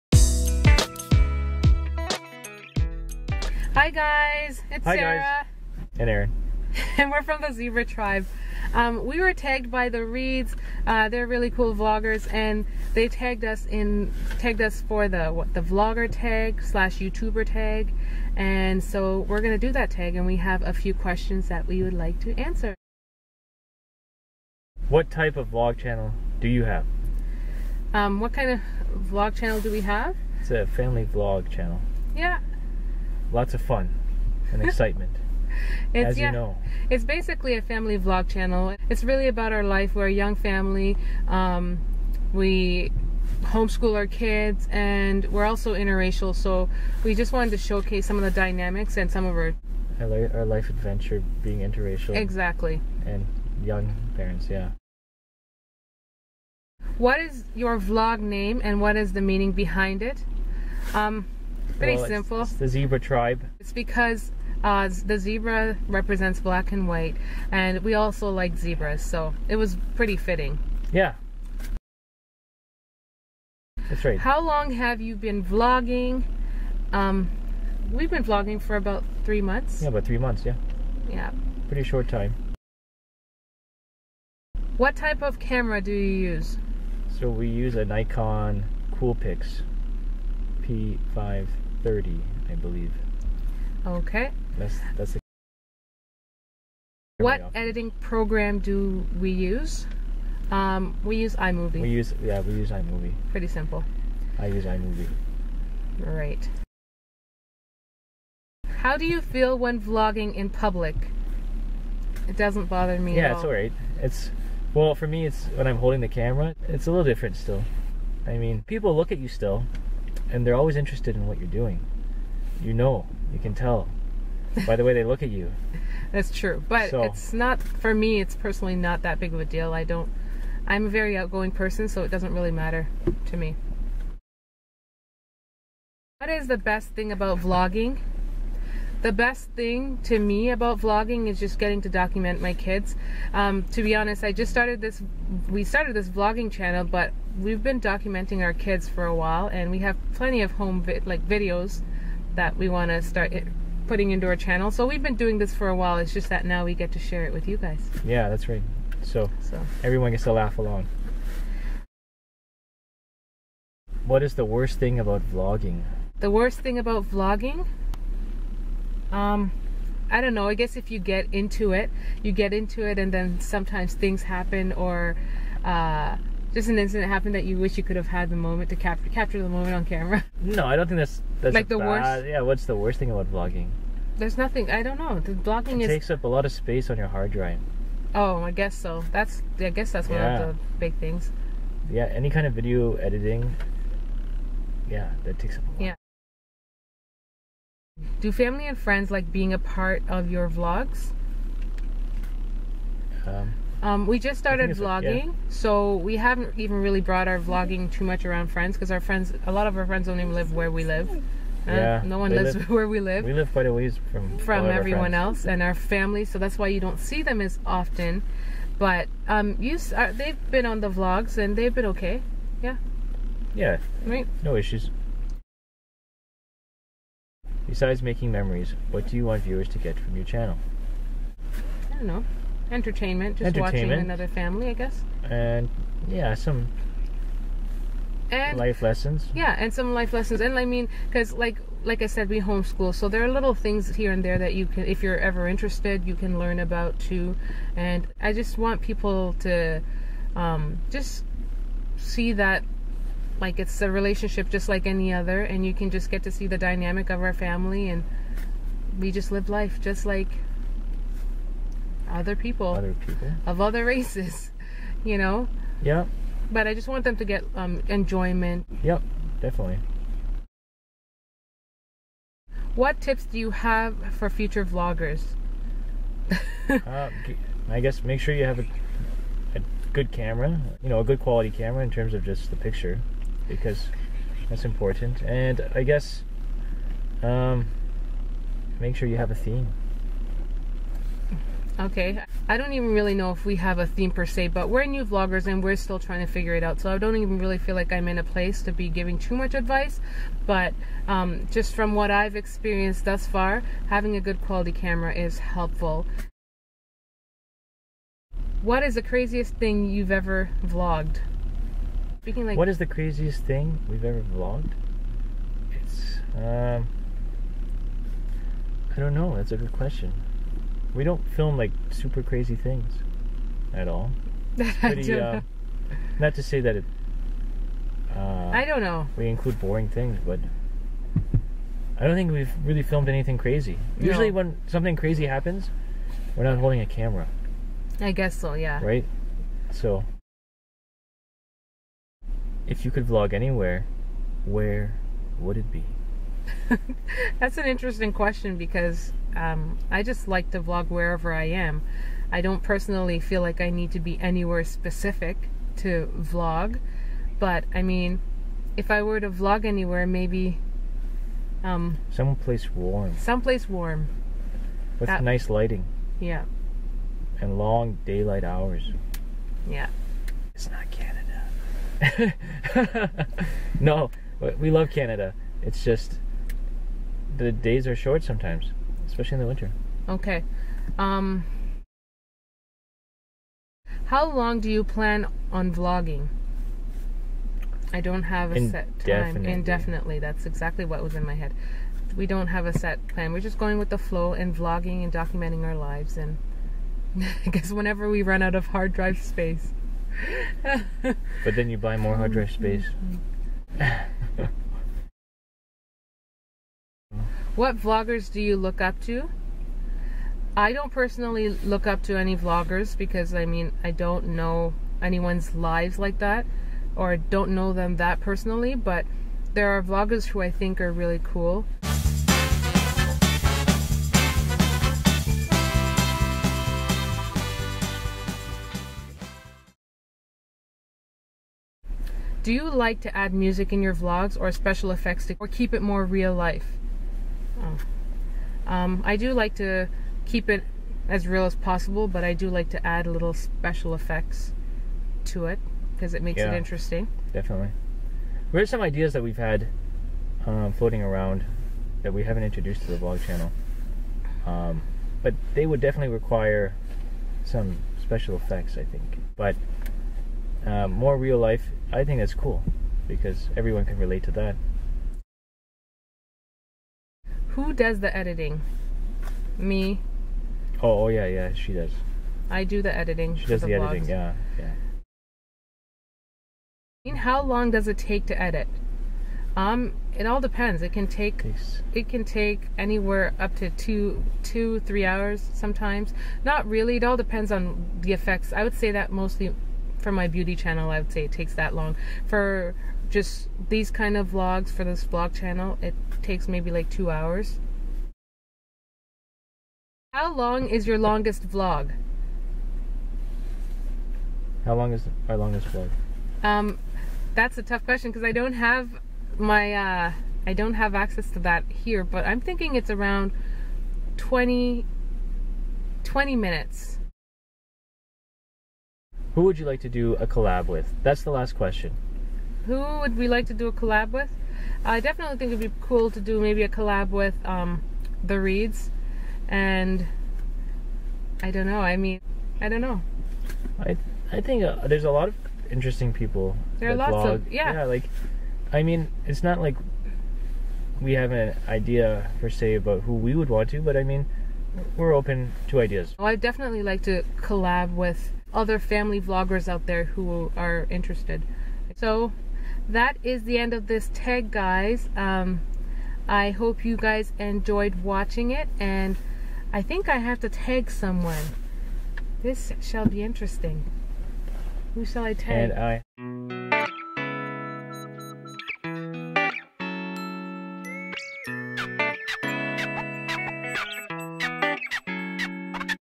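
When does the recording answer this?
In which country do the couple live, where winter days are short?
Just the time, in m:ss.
6:14.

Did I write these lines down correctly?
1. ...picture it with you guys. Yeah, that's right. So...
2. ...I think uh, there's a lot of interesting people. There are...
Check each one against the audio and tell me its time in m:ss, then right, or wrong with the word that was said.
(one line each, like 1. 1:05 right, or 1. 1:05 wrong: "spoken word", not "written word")
1. 2:36 wrong: "share", not "picture"
2. 8:54 right.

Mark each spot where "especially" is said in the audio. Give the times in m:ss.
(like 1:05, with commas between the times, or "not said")
6:19.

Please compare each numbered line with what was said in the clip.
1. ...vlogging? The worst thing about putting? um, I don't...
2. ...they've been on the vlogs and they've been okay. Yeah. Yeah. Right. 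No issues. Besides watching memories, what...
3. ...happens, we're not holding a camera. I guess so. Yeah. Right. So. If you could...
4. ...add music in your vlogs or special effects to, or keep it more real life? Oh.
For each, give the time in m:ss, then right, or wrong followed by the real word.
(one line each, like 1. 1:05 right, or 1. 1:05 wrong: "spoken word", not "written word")
1. 2:45 wrong: "vlogging", not "putting"
2. 3:40 wrong: "making", not "watching"
3. 5:35 right
4. 7:13 right.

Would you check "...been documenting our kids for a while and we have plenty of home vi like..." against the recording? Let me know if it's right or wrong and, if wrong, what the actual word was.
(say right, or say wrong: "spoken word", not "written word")
right.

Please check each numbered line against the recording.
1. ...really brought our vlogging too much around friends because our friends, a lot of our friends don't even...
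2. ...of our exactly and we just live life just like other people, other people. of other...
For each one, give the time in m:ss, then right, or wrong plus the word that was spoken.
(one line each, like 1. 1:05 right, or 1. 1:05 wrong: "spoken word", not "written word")
1. 3:26 right
2. 4:17 wrong: "family", not "exactly".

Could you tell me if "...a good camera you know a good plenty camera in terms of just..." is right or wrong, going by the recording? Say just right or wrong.
wrong.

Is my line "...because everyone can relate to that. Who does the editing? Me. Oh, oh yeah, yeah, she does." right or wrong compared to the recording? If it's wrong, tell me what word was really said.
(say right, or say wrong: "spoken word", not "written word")
right.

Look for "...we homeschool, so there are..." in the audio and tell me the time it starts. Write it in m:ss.
4:02.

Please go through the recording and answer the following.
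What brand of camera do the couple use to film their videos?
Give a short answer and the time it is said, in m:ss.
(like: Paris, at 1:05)
Nikon, at 1:27.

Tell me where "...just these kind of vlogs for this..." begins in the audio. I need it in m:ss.
8:13.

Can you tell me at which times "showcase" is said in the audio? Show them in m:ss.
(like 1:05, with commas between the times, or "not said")
0:47.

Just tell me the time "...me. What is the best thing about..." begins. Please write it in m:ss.
2:13.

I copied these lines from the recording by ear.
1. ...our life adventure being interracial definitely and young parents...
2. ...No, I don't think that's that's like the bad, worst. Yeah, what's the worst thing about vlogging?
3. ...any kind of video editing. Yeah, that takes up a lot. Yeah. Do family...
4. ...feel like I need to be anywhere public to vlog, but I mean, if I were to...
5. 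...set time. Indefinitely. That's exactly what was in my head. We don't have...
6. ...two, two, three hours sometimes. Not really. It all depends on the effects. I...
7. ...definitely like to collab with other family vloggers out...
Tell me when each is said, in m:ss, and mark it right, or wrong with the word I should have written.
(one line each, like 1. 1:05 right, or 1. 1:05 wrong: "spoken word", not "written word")
1. 0:49 wrong: "exactly", not "definitely"
2. 3:00 right
3. 3:12 right
4. 5:53 wrong: "specific", not "public"
5. 6:28 right
6. 8:03 right
7. 9:06 right.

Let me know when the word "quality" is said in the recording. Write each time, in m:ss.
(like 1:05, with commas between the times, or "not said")
4:41, 5:04.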